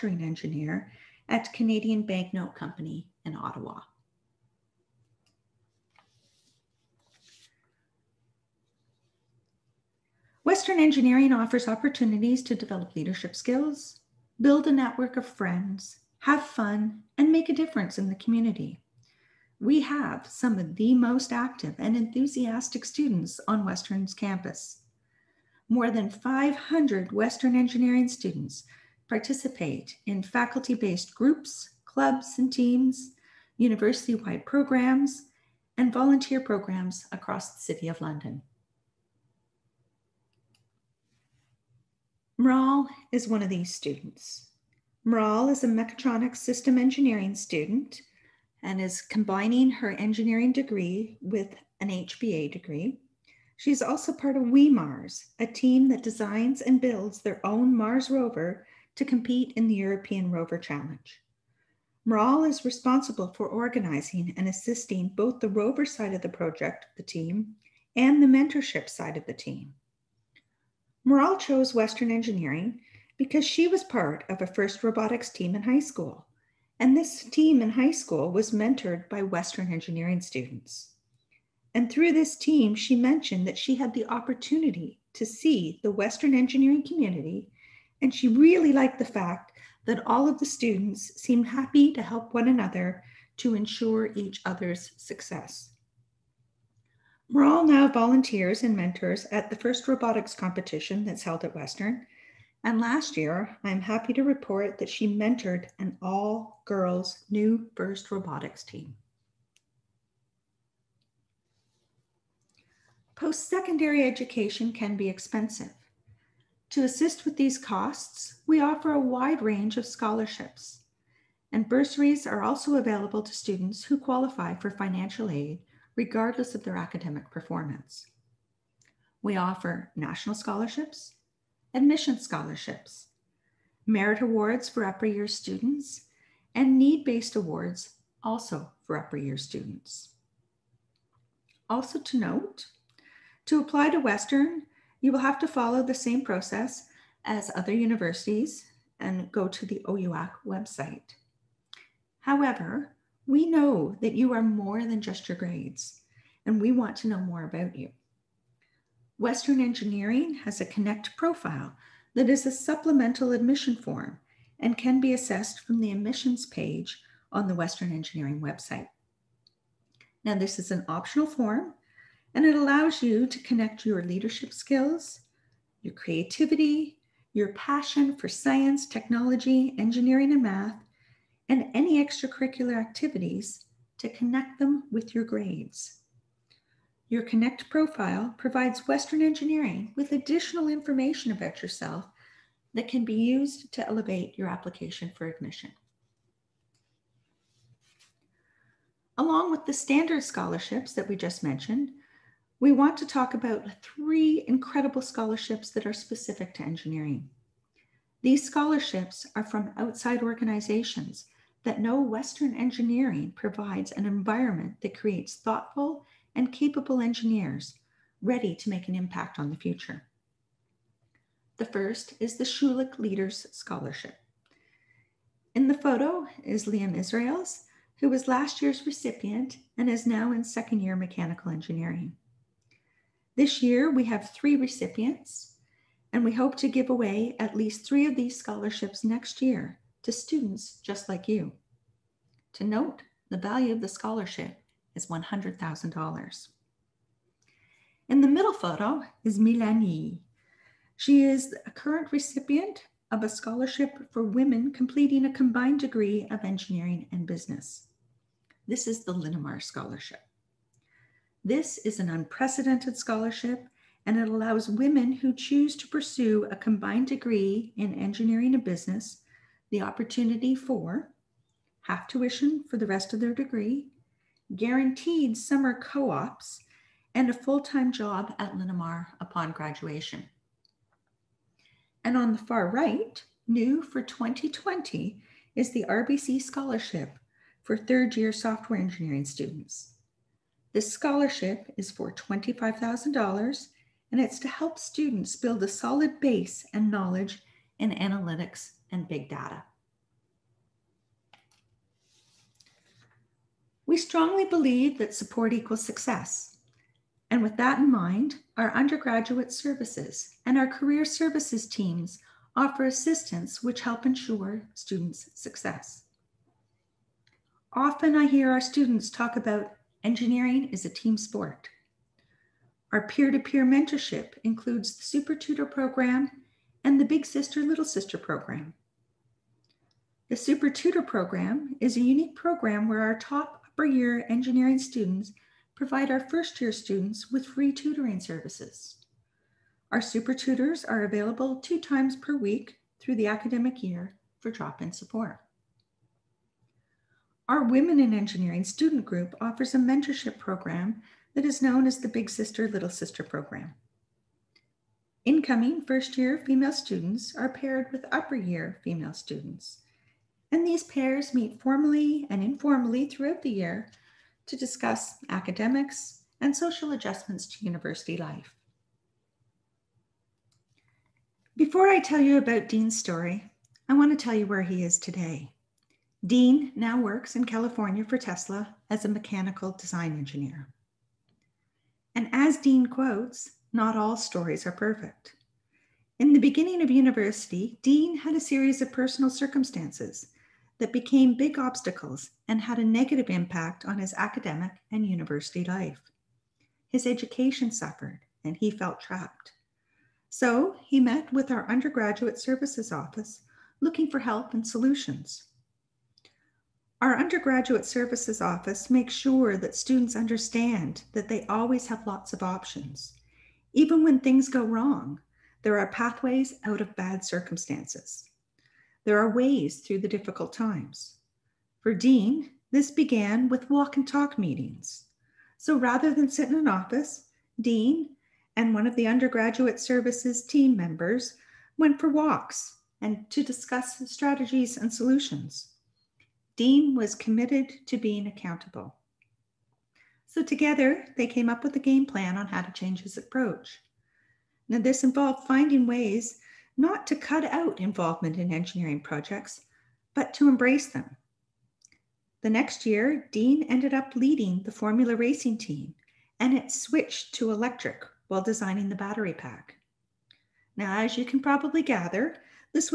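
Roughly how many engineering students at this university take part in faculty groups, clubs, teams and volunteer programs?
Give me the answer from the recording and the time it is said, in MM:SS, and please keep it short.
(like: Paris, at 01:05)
500, at 00:26.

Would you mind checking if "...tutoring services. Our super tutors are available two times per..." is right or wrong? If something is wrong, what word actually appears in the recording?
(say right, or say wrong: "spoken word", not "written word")
right.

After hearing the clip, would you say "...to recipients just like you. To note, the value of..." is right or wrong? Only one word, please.
wrong.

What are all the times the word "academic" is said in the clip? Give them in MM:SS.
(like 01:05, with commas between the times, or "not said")
02:06, 05:43, 06:05, 06:34.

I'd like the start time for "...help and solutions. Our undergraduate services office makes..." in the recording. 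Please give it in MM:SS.
06:44.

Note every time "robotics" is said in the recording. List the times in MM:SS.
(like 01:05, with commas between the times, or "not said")
01:14, 01:39, 01:48.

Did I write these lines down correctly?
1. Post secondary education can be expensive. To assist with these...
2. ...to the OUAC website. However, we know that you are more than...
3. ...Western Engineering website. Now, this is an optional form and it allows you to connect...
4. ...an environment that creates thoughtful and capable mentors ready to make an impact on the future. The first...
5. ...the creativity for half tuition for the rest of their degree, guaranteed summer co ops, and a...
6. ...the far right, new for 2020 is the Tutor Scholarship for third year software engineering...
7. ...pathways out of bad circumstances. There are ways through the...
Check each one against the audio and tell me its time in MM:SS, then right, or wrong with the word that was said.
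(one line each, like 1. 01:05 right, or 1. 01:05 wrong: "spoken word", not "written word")
1. 01:53 right
2. 02:29 right
3. 02:47 right
4. 03:33 wrong: "engineers", not "mentors"
5. 04:29 wrong: "opportunity", not "creativity"
6. 04:42 wrong: "RBC", not "Tutor"
7. 06:55 right.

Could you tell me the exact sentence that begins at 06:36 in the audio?
His education suffered and he felt trapped.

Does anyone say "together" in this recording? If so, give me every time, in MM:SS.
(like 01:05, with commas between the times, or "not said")
07:20.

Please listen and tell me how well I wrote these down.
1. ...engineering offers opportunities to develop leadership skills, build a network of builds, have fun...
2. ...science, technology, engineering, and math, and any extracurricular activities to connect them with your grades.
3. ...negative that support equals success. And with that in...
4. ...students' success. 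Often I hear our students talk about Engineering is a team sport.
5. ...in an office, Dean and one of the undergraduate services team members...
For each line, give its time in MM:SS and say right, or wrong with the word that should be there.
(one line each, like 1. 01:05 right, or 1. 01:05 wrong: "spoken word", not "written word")
1. 00:10 wrong: "friends", not "builds"
2. 02:58 right
3. 05:04 wrong: "believe", not "negative"
4. 05:14 right
5. 07:06 right.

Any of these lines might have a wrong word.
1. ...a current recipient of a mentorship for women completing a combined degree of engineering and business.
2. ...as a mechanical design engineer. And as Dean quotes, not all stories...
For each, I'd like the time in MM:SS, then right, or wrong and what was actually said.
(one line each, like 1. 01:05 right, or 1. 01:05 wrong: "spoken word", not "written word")
1. 04:11 wrong: "scholarship", not "mentorship"
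2. 06:18 right.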